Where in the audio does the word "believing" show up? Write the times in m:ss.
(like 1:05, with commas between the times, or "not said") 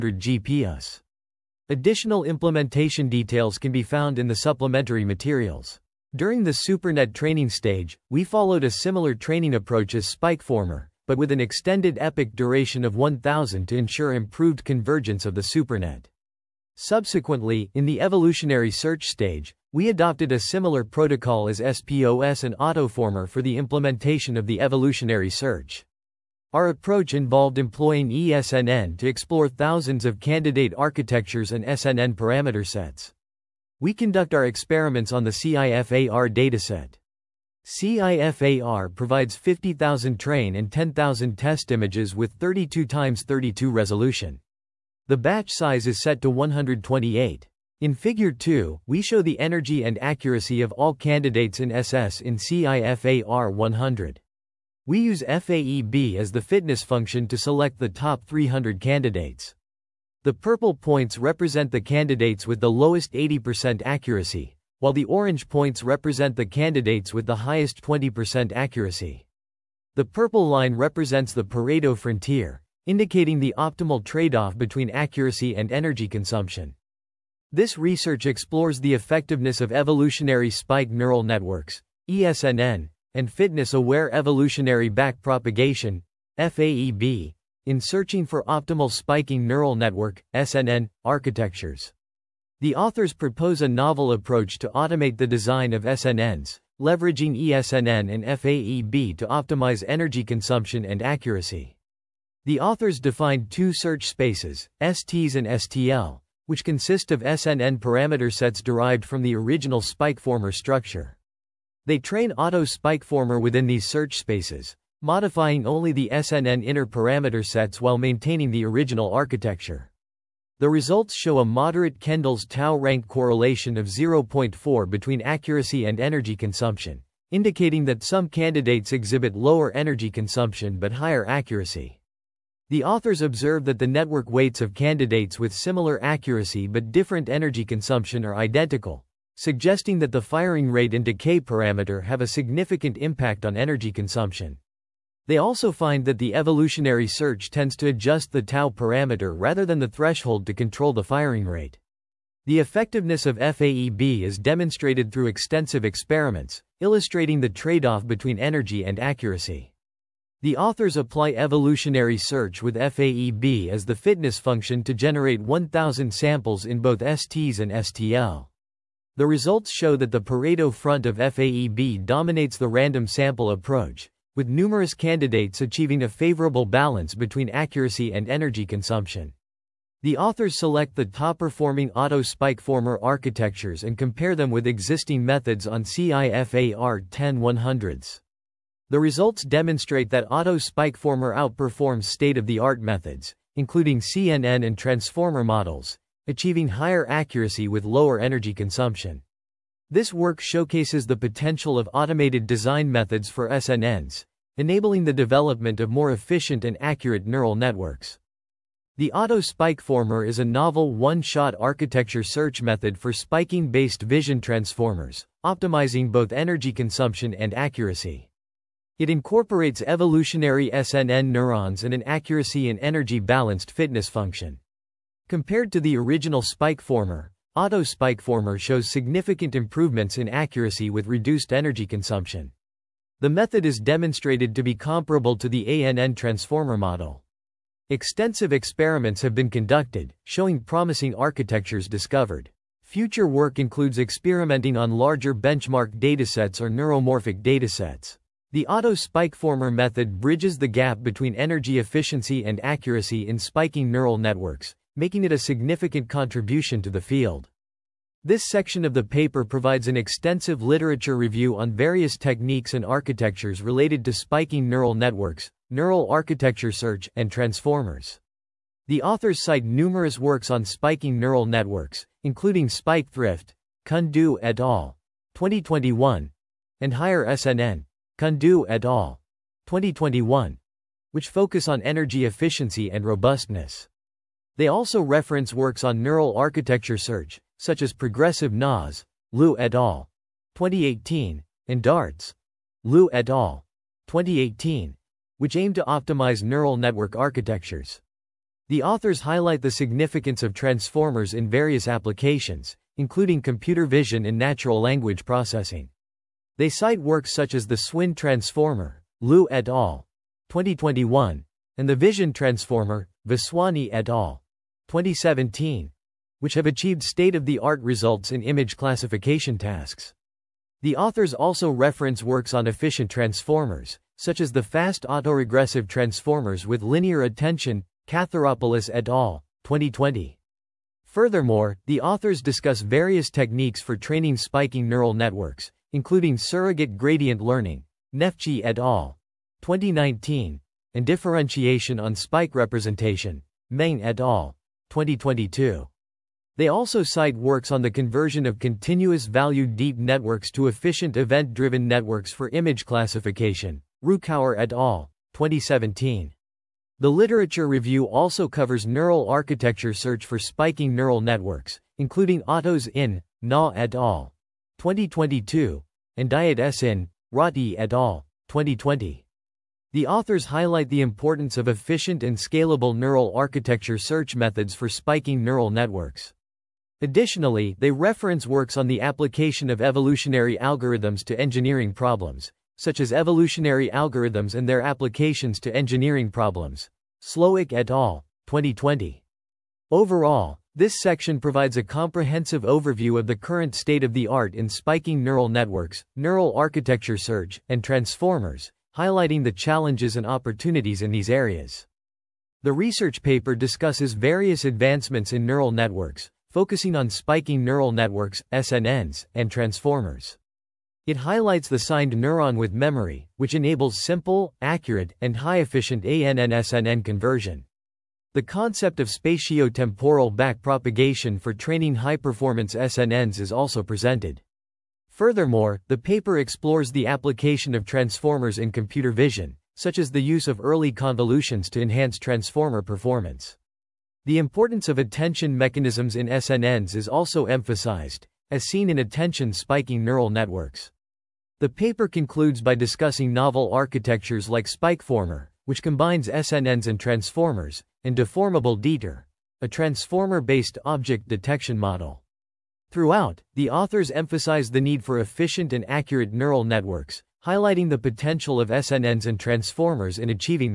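not said.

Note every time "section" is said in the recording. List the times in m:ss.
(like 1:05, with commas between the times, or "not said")
4:18, 6:31.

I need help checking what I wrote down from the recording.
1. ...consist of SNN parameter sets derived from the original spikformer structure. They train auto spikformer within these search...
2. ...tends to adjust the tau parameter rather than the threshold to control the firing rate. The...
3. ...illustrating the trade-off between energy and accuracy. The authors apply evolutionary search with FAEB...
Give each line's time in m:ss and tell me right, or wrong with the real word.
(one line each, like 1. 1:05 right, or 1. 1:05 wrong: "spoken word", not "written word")
1. 1:46 right
2. 2:27 right
3. 2:36 right.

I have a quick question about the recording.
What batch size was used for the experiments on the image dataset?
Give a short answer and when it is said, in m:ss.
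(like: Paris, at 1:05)
128, at 0:46.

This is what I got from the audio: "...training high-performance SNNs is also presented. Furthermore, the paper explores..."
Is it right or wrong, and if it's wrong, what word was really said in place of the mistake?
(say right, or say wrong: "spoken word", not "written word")
right.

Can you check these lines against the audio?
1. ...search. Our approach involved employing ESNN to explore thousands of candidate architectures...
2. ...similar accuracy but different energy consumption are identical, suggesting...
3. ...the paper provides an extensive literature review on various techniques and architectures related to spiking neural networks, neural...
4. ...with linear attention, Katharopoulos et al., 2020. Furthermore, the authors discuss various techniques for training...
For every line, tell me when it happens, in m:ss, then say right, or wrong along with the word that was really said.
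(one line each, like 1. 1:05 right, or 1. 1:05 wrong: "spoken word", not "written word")
1. 0:25 right
2. 2:15 right
3. 4:18 right
4. 5:26 right.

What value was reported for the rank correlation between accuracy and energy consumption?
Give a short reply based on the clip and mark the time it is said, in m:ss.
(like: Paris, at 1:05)
0.4, at 2:03.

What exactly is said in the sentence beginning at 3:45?
Compared to the original spikformer, Auto spikformer shows significant improvements in accuracy with reduced energy consumption.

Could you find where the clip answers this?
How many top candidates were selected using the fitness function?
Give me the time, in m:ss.
0:58.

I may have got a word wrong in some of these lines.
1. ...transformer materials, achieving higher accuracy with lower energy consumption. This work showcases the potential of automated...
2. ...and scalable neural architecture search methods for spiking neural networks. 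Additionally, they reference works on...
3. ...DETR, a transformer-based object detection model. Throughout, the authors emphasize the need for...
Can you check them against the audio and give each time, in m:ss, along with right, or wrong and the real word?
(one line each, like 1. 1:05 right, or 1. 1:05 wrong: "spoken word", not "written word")
1. 3:14 wrong: "models", not "materials"
2. 6:12 right
3. 7:28 right.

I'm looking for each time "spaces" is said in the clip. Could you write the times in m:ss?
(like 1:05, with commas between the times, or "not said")
1:44, 1:54.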